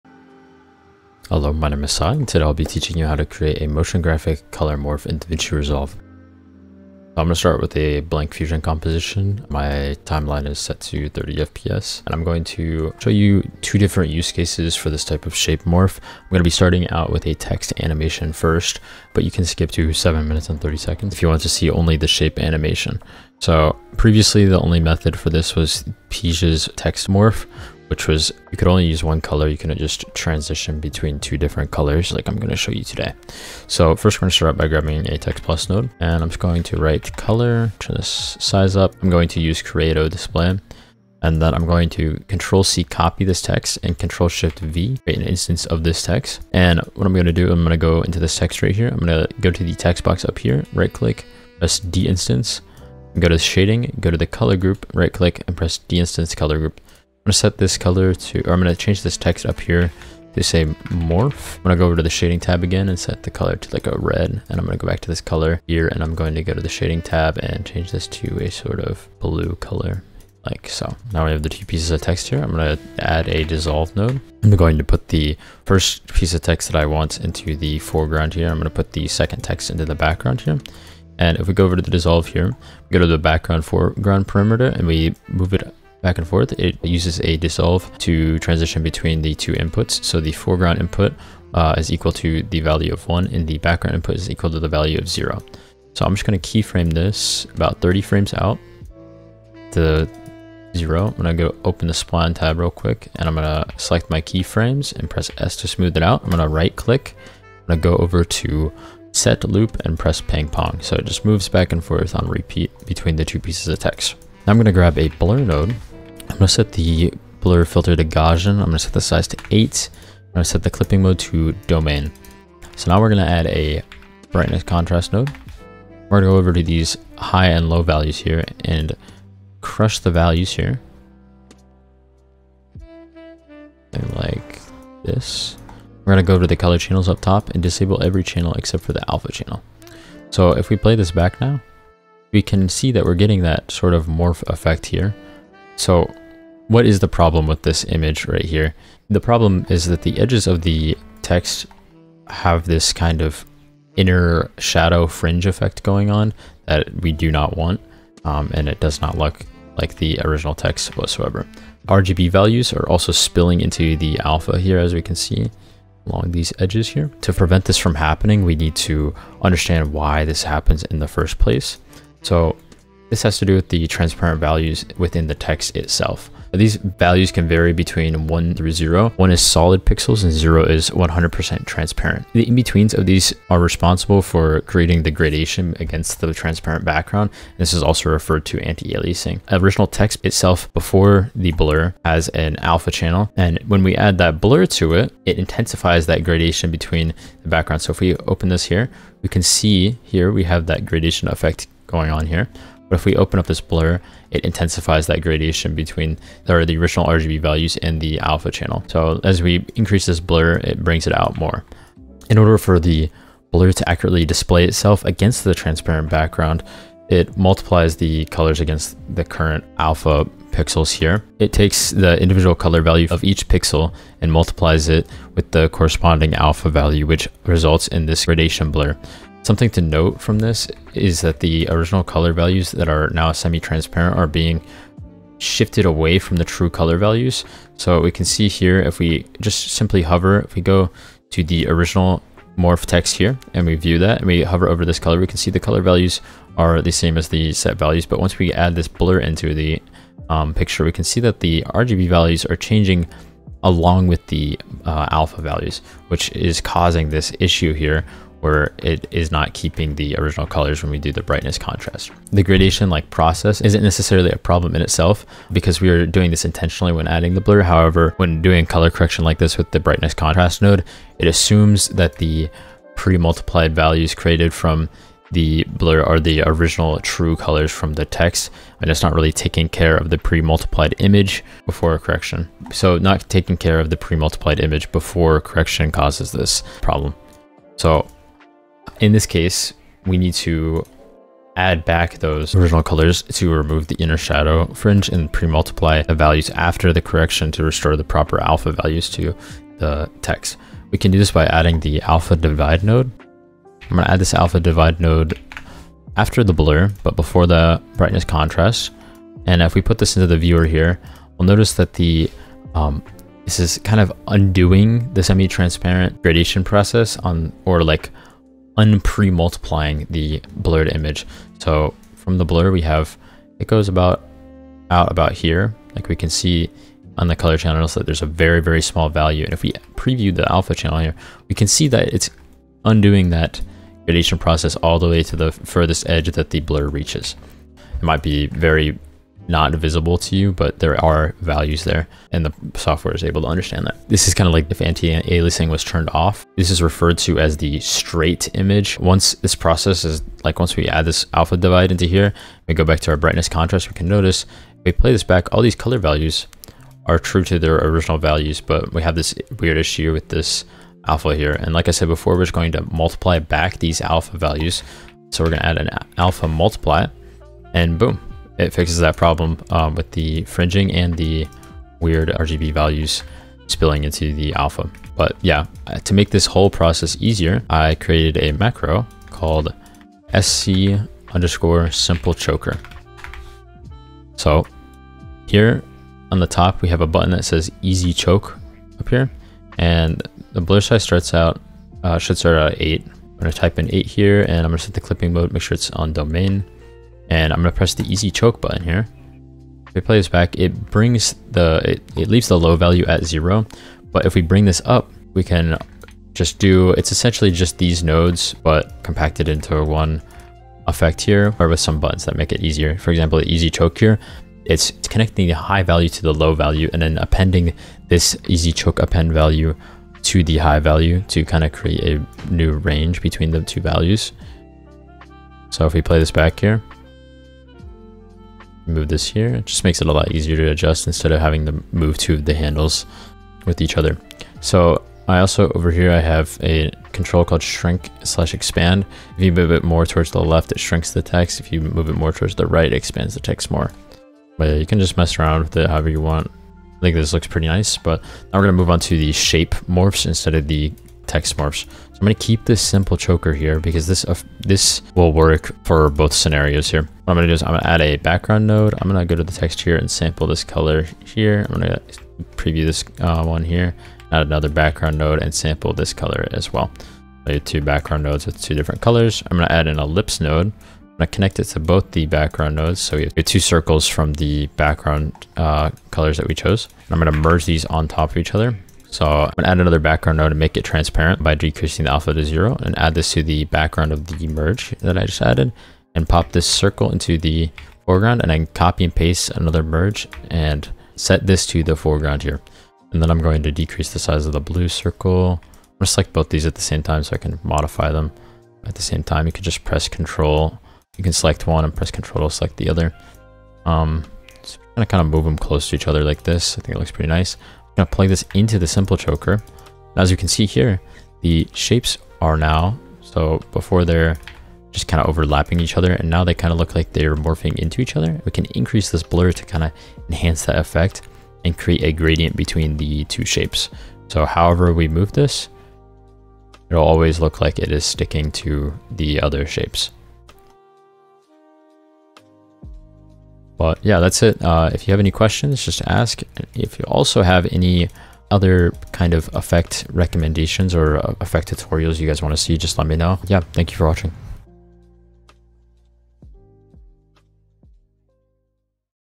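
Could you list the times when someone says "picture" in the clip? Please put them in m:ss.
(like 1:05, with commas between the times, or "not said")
4:10.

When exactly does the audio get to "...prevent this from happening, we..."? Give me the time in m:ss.
2:47.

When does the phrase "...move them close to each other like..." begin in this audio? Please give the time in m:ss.
8:25.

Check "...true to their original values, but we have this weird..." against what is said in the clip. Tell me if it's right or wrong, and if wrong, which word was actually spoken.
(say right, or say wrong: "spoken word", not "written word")
right.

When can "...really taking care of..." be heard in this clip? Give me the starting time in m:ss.
4:39.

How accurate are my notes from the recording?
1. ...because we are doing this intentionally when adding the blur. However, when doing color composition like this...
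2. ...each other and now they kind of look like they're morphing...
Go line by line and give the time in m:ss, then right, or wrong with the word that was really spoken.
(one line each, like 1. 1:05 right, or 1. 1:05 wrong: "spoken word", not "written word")
1. 4:25 wrong: "correction", not "composition"
2. 8:35 right.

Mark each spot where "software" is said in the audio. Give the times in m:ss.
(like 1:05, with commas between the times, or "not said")
5:42.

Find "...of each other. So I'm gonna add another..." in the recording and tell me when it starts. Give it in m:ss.
7:58.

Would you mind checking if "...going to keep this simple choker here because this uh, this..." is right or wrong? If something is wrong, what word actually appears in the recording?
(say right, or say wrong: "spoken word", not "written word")
right.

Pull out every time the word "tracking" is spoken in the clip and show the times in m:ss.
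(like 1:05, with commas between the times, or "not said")
not said.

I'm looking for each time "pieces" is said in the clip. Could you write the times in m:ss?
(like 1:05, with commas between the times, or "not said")
1:11, 1:16, 1:53.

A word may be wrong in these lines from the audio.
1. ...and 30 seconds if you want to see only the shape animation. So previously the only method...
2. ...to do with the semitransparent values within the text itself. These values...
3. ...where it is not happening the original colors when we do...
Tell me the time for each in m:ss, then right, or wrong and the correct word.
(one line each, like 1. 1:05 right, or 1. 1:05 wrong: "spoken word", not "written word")
1. 0:20 right
2. 2:53 wrong: "transparent", not "semitransparent"
3. 4:18 wrong: "keeping", not "happening".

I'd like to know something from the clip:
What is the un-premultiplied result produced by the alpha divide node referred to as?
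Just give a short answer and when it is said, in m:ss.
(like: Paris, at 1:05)
Straight image, at 5:47.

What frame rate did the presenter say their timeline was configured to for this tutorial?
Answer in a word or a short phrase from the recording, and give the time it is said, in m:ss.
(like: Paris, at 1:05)
30 FPS, at 0:11.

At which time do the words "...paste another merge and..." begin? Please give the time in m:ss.
8:09.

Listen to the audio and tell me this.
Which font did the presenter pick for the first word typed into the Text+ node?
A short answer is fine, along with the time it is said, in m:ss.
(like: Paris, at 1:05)
Creato Display, at 0:39.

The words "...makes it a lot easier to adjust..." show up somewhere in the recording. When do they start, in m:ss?
7:09.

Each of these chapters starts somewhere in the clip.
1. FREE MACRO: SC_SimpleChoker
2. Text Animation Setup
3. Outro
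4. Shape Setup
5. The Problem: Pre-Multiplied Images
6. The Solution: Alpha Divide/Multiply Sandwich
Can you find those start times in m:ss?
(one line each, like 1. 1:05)
1. 6:17
2. 0:33
3. 8:52
4. 7:30
5. 2:25
6. 5:00.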